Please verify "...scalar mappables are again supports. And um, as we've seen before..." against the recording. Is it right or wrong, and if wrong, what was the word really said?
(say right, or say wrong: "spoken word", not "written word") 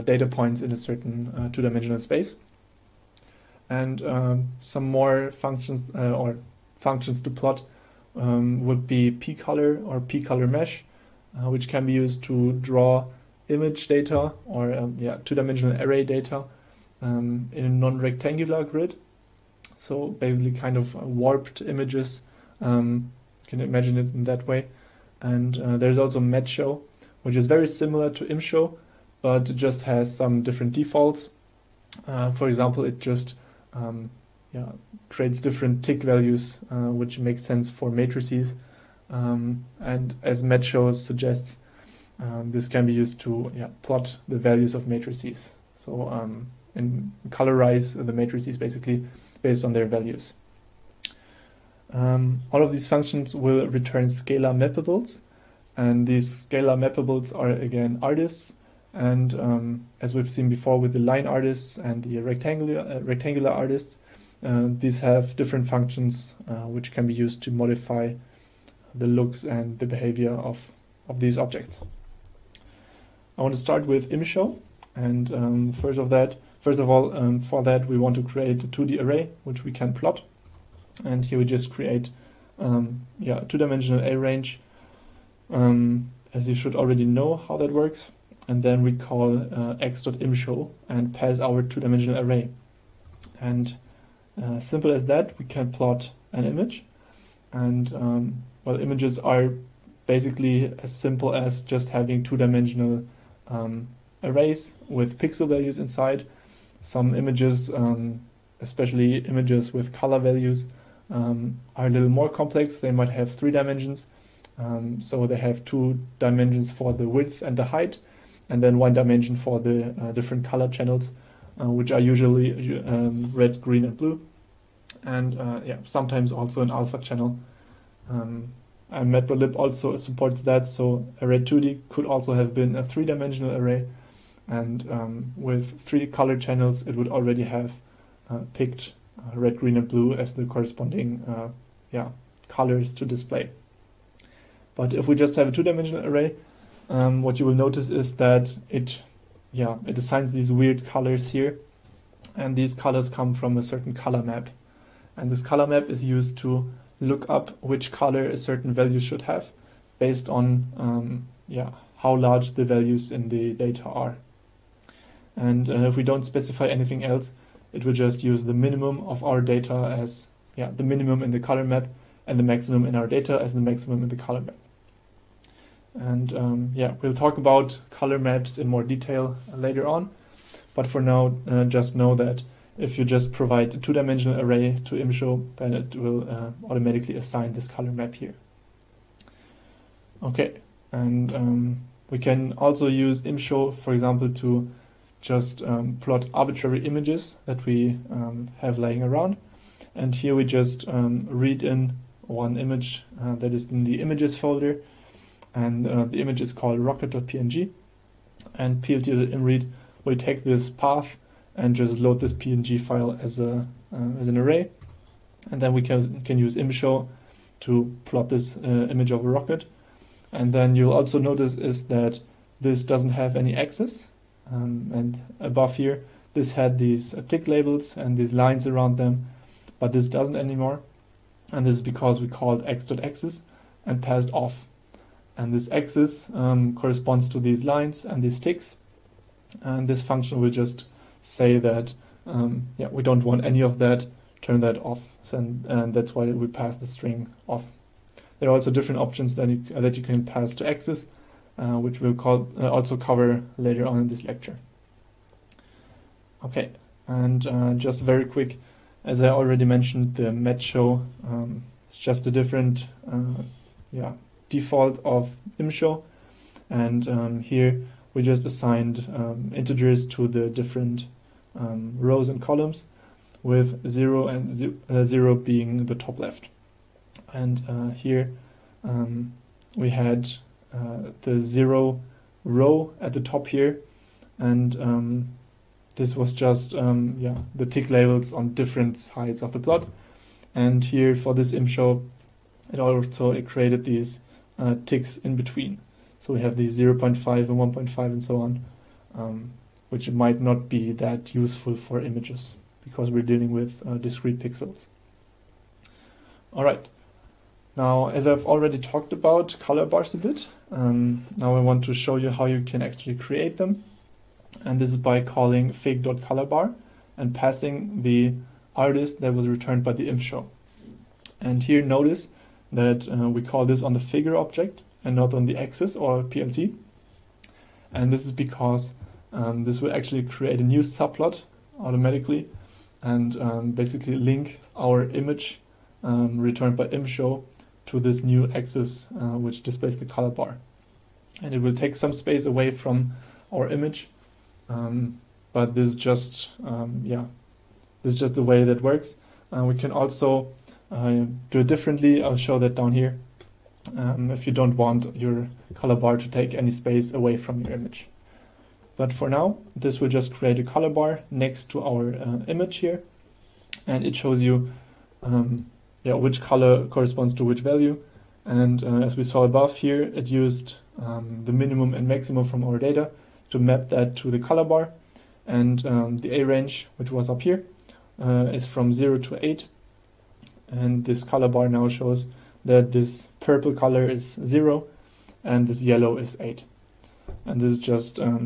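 wrong: "artists", not "supports".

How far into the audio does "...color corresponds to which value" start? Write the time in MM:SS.
06:06.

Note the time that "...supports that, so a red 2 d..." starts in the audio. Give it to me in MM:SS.
02:09.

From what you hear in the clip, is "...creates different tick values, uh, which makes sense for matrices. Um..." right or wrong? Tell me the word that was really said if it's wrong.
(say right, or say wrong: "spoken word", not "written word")
right.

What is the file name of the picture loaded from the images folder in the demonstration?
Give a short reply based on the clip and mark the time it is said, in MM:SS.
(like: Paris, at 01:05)
rocket.png, at 03:26.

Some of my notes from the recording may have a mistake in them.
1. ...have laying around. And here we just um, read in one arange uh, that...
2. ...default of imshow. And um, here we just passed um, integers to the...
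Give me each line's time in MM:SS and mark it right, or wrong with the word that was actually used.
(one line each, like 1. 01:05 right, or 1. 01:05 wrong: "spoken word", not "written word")
1. 03:18 wrong: "image", not "arange"
2. 04:24 wrong: "assigned", not "passed".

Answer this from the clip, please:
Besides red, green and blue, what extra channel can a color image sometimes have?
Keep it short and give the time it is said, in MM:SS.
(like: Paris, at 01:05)
alpha channel, at 02:06.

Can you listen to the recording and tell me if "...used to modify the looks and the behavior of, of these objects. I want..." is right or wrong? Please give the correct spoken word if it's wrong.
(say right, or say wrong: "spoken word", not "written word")
right.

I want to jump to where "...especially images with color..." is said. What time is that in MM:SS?
01:48.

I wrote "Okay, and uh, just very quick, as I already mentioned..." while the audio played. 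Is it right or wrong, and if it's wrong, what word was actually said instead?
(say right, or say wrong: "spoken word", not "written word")
right.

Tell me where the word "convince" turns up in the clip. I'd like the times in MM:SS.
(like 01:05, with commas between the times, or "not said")
not said.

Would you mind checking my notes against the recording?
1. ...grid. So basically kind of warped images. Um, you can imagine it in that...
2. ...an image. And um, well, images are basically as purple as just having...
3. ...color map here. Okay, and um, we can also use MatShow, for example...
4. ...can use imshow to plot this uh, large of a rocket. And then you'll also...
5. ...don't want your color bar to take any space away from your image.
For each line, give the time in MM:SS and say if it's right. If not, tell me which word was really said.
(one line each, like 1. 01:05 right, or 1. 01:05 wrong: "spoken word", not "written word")
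1. 00:18 right
2. 01:36 wrong: "simple", not "purple"
3. 03:07 wrong: "ImShow", not "MatShow"
4. 03:36 wrong: "image", not "large"
5. 05:54 right.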